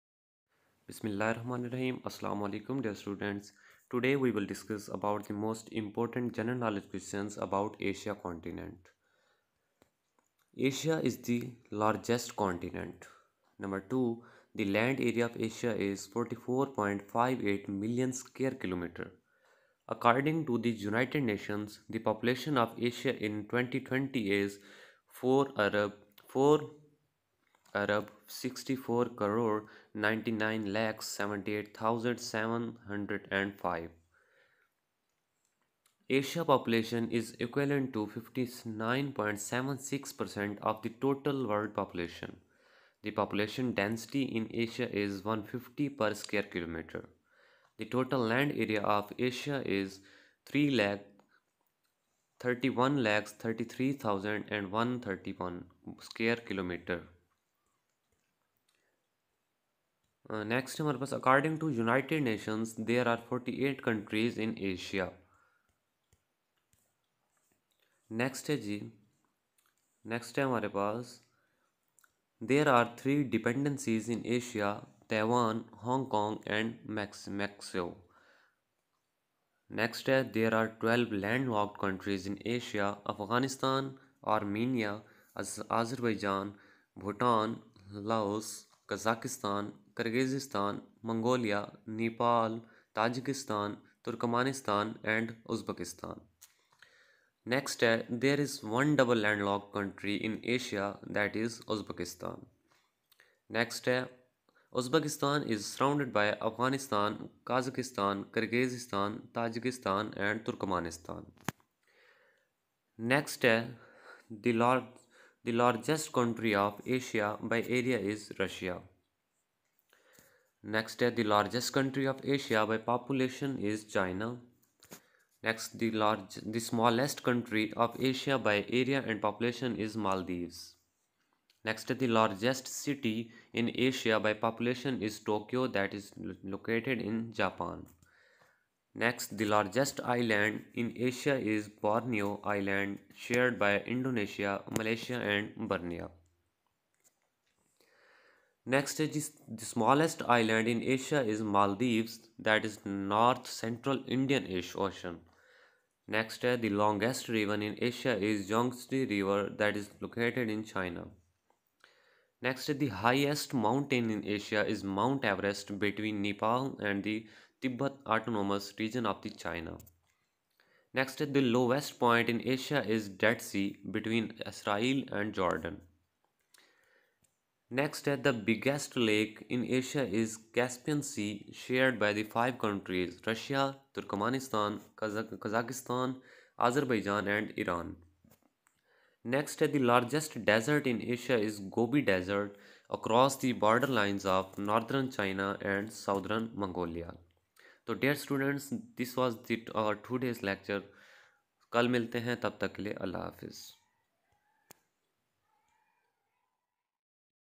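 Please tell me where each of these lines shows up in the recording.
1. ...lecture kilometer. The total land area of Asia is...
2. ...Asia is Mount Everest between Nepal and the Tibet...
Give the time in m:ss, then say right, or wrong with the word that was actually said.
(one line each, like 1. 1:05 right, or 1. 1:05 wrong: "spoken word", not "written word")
1. 0:46 wrong: "square", not "lecture"
2. 2:44 right.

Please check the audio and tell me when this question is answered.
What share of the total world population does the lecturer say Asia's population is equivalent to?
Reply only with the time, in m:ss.
0:38.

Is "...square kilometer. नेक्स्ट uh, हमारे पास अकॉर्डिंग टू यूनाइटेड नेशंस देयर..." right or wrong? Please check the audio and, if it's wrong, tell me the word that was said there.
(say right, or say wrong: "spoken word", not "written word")
right.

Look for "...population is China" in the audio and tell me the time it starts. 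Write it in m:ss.
2:02.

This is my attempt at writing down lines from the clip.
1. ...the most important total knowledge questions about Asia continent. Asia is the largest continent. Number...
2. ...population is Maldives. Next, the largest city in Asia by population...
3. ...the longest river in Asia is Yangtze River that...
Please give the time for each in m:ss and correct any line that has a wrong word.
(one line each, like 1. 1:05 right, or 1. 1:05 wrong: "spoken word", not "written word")
1. 0:05 wrong: "general", not "total"
2. 2:09 right
3. 2:36 right.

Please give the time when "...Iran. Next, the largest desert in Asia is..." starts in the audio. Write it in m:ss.
3:07.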